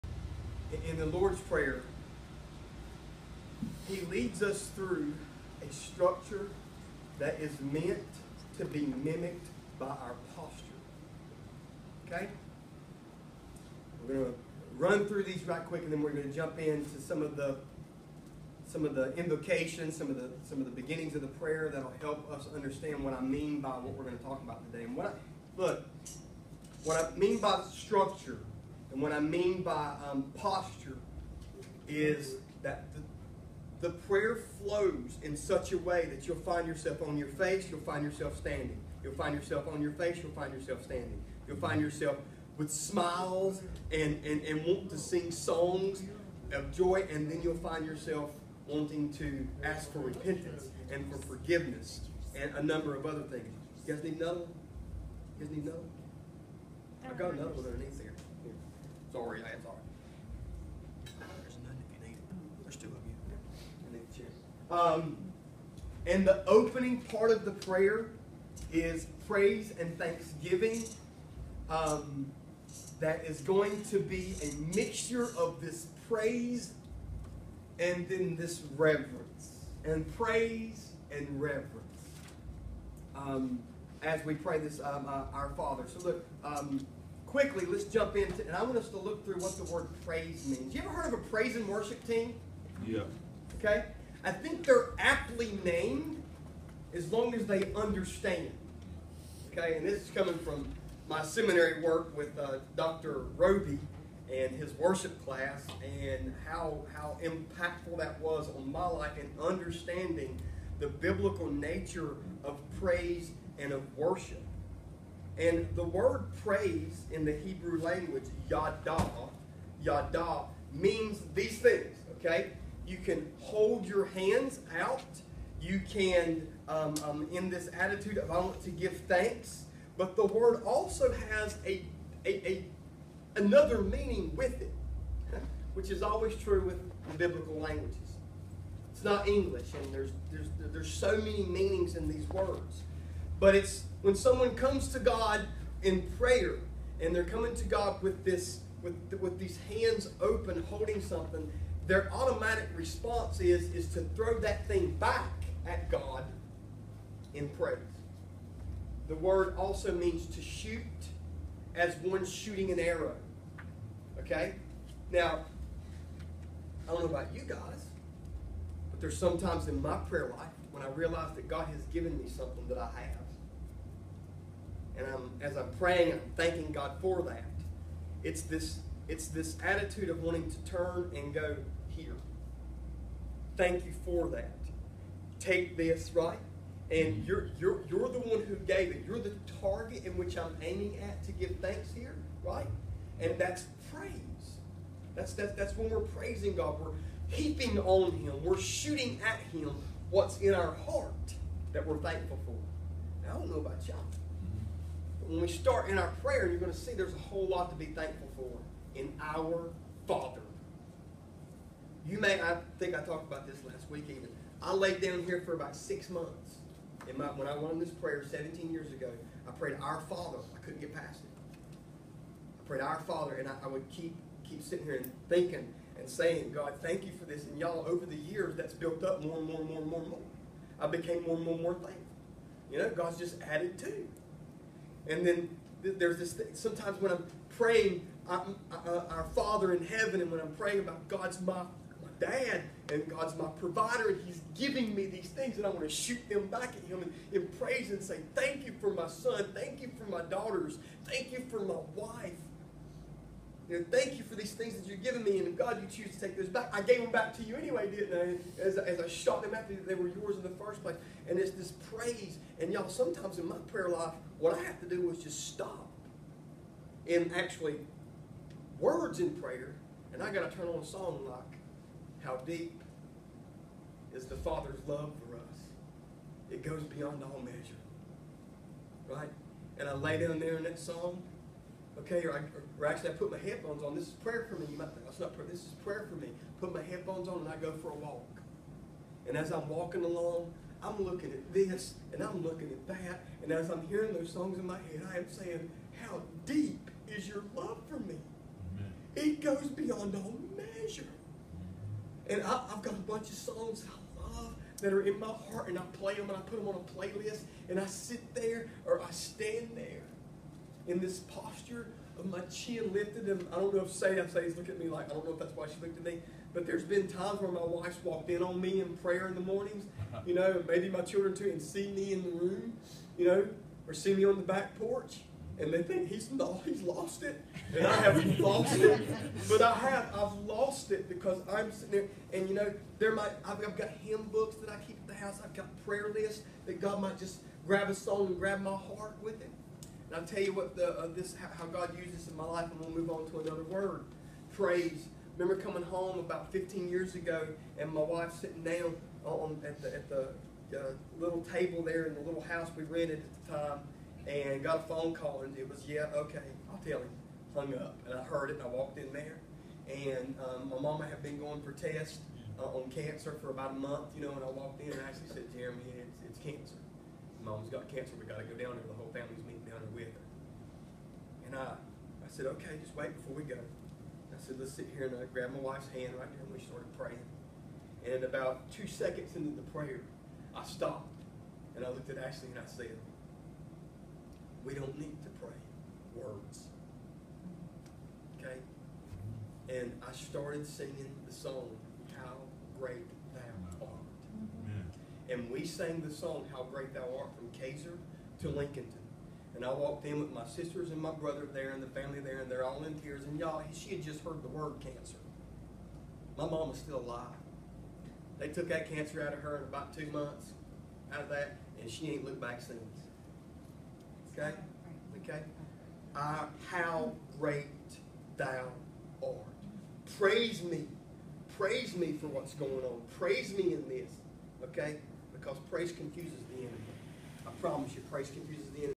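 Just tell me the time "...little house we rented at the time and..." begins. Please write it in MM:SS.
05:52.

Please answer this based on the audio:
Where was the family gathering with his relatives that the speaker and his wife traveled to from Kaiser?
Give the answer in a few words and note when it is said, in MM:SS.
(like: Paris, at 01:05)
Lincolnton, at 06:38.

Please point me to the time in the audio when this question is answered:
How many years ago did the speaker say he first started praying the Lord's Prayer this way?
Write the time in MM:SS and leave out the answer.
03:38.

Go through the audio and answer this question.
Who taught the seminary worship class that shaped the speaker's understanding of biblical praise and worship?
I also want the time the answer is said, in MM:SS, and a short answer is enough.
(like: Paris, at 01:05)
Dr. Roby, at 01:42.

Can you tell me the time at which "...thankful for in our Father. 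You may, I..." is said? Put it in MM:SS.
03:27.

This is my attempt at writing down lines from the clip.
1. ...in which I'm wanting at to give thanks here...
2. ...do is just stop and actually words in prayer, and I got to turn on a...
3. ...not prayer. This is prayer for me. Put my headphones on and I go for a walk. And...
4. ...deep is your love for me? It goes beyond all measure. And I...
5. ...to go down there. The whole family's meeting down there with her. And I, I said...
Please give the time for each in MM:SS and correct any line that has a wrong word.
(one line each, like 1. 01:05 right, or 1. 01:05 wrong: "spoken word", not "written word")
1. 03:10 wrong: "aiming", not "wanting"
2. 04:24 right
3. 04:45 right
4. 04:56 right
5. 06:08 right.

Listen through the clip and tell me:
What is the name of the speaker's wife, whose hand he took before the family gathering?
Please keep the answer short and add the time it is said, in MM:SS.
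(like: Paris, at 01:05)
Ashley, at 06:22.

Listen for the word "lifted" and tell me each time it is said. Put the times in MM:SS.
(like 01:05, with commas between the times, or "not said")
05:12.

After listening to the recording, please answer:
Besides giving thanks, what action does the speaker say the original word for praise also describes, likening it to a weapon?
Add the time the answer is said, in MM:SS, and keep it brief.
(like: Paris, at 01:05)
shooting an arrow, at 02:42.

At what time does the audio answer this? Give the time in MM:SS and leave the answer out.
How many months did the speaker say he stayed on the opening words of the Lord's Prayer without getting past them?
03:35.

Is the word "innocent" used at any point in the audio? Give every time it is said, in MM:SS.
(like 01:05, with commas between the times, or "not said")
not said.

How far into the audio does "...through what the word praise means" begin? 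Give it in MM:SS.
01:29.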